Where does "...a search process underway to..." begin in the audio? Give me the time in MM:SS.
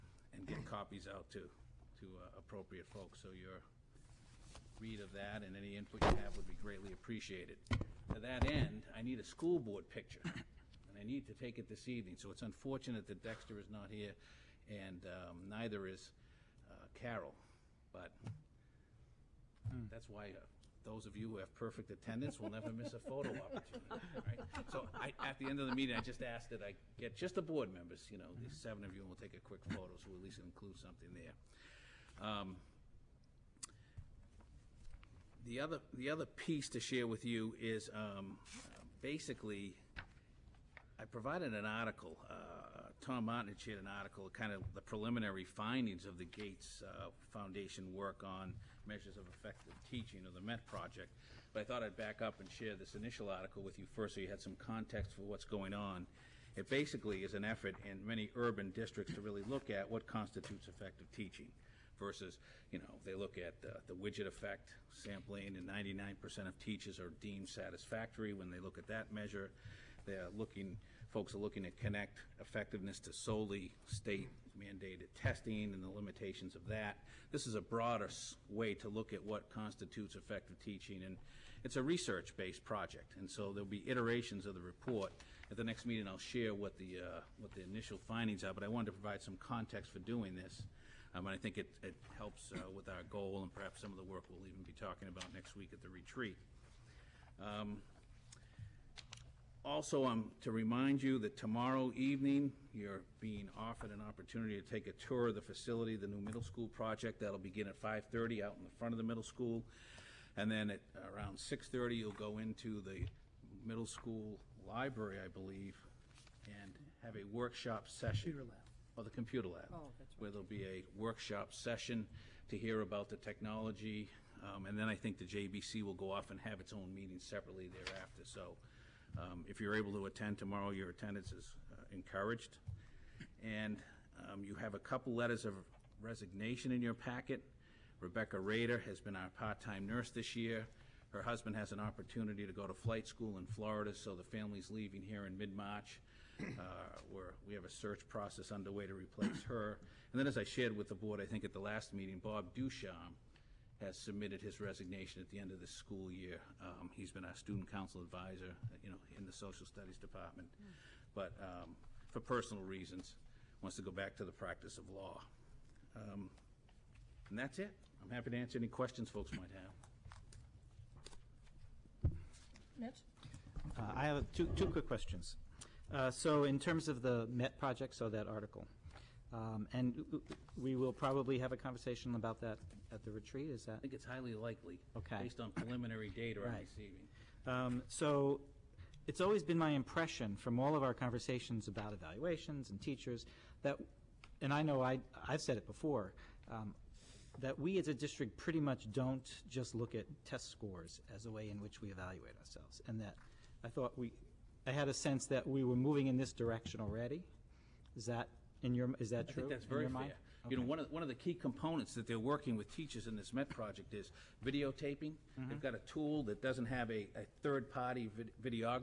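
02:27.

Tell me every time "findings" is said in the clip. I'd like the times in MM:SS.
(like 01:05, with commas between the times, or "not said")
00:45, 01:27.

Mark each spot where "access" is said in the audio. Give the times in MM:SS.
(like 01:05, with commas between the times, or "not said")
not said.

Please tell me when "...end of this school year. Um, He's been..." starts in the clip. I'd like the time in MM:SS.
02:35.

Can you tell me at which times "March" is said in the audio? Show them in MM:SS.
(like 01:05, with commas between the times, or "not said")
02:25.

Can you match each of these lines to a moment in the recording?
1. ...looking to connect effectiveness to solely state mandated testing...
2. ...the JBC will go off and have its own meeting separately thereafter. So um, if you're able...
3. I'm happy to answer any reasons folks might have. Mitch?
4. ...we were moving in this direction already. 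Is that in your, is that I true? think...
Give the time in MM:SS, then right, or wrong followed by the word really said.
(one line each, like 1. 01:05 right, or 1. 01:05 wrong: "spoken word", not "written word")
1. 01:11 right
2. 02:05 right
3. 02:48 wrong: "questions", not "reasons"
4. 03:25 right.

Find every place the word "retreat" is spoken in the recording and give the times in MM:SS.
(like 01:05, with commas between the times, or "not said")
01:35, 03:03.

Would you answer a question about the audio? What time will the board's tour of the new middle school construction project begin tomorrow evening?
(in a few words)
5:30.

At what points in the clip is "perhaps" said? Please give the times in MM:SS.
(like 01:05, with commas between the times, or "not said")
01:33.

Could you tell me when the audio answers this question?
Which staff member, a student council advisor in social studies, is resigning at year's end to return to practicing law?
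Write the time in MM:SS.
02:32.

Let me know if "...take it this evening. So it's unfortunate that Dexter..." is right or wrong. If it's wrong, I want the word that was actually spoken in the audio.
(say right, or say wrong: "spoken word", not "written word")
right.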